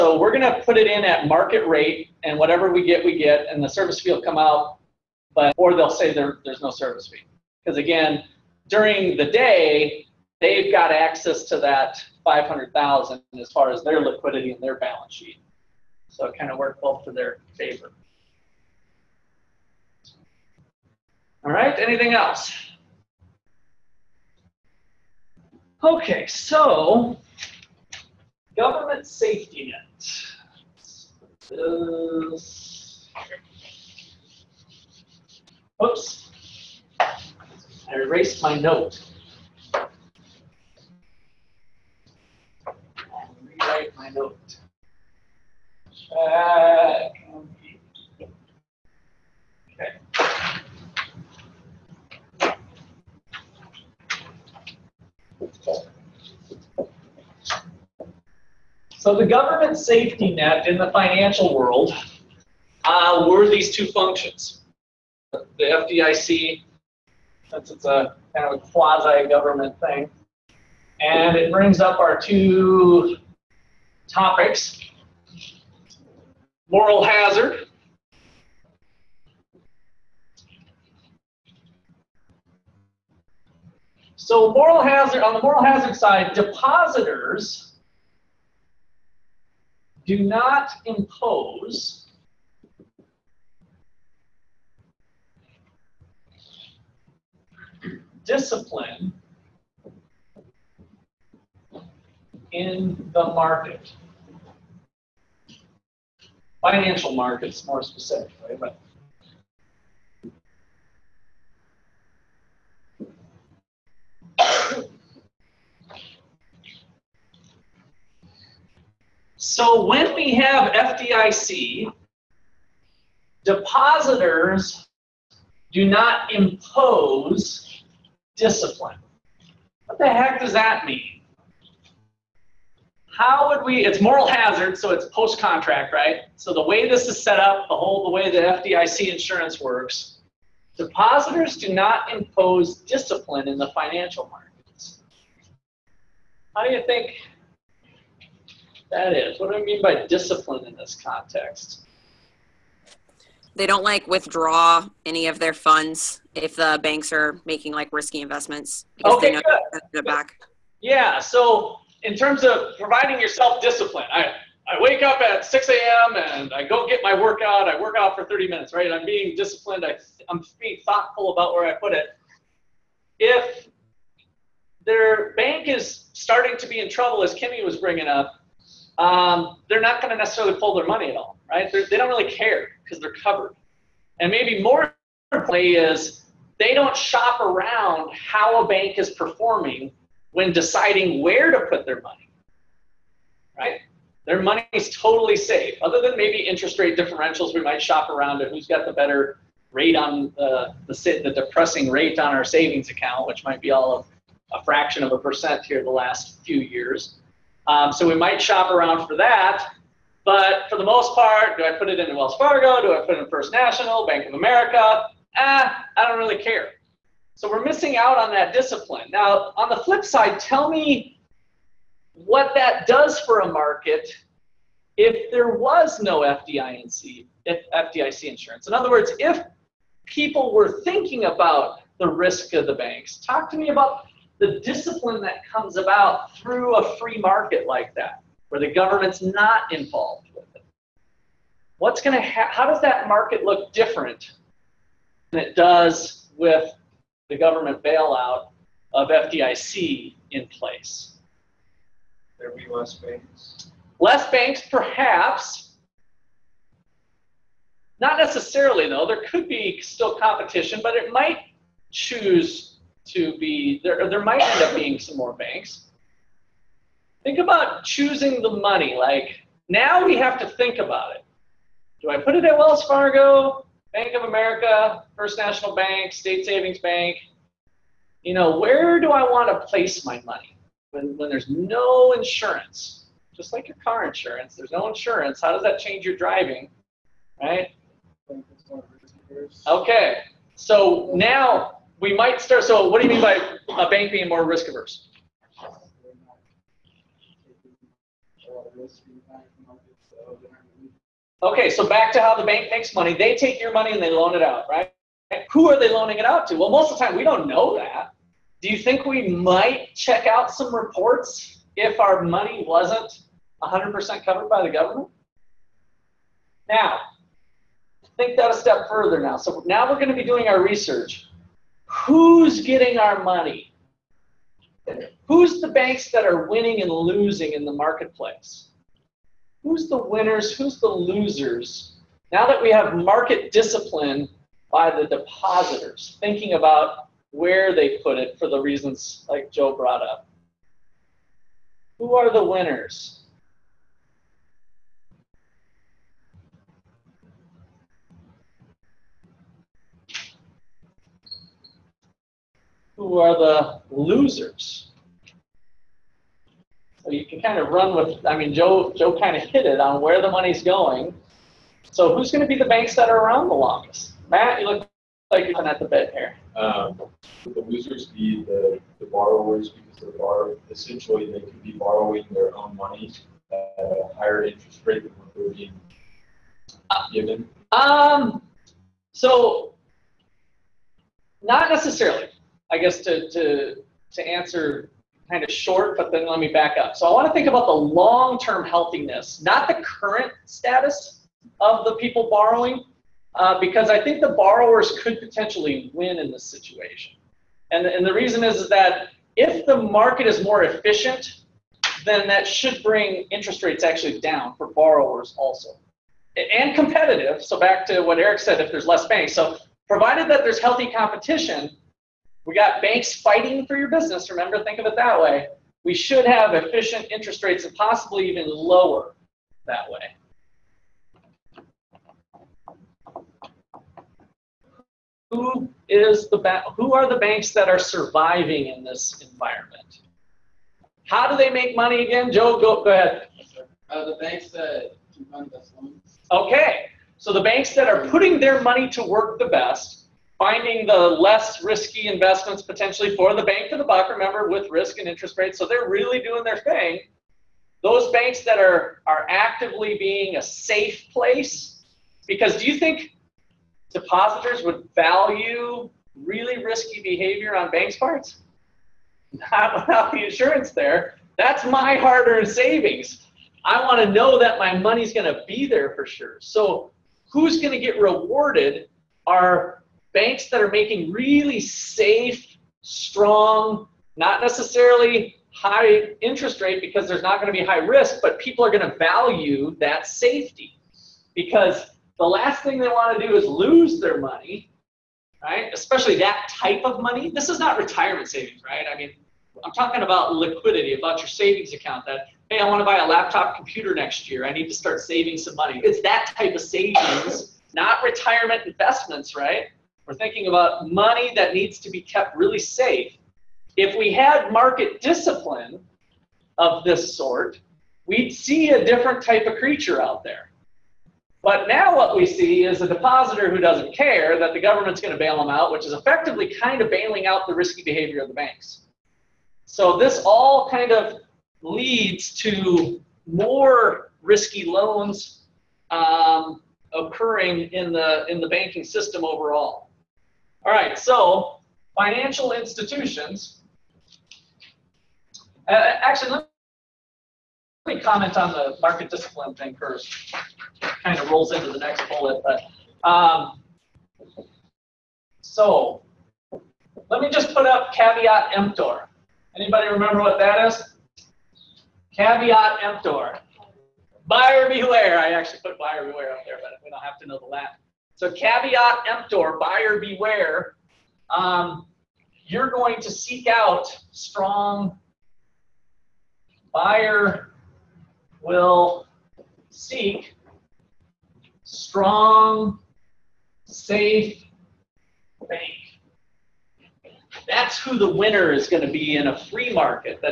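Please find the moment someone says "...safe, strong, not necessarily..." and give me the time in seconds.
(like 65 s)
471 s.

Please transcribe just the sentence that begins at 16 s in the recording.
So it kind of worked both to their favor.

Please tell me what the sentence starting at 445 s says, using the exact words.
So they're really doing their thing.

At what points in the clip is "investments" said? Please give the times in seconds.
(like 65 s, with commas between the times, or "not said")
158 s, 442 s, 498 s.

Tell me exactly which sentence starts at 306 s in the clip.
Well, most of the time we don't know that.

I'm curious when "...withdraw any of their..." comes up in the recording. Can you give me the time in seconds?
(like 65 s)
154 s.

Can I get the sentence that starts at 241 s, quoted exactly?
What's going to ha- how does that market look different than it does with the government bailout of FDIC in place?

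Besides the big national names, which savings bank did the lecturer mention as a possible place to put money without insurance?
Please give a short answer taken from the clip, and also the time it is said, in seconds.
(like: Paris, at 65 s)
State Savings Bank, at 276 s.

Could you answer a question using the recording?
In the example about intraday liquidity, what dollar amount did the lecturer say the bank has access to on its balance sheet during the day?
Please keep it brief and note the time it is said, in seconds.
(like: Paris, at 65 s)
500,000, at 12 s.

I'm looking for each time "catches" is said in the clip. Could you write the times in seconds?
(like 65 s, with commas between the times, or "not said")
not said.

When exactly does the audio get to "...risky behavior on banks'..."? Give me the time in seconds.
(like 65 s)
456 s.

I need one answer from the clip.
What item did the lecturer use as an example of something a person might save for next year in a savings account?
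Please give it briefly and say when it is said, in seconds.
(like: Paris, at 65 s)
laptop computer, at 493 s.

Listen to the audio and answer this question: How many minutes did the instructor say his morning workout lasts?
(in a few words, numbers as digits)
30.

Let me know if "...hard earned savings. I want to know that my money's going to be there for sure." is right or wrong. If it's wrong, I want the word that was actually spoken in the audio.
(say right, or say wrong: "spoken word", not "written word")
right.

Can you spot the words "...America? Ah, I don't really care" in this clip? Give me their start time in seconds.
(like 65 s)
214 s.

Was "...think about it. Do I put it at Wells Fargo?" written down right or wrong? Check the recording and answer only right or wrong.
right.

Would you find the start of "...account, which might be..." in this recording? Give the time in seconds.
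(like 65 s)
202 s.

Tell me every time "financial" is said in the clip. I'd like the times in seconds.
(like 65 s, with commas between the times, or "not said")
60 s, 106 s, 143 s, 531 s.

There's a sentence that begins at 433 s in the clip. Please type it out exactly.
Uh, the banks that can fund loans.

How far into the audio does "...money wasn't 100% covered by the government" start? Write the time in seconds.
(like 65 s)
312 s.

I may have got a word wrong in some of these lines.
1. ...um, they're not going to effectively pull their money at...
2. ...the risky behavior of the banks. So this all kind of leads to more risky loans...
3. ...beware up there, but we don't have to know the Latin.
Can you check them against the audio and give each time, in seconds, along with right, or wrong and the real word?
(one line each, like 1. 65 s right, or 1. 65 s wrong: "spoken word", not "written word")
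1. 178 s wrong: "necessarily", not "effectively"
2. 517 s right
3. 556 s right.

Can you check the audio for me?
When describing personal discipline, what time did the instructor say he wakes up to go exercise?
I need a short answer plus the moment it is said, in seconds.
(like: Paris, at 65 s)
6 a.m., at 165 s.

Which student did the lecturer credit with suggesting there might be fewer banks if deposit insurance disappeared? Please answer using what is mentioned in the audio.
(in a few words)
Eric.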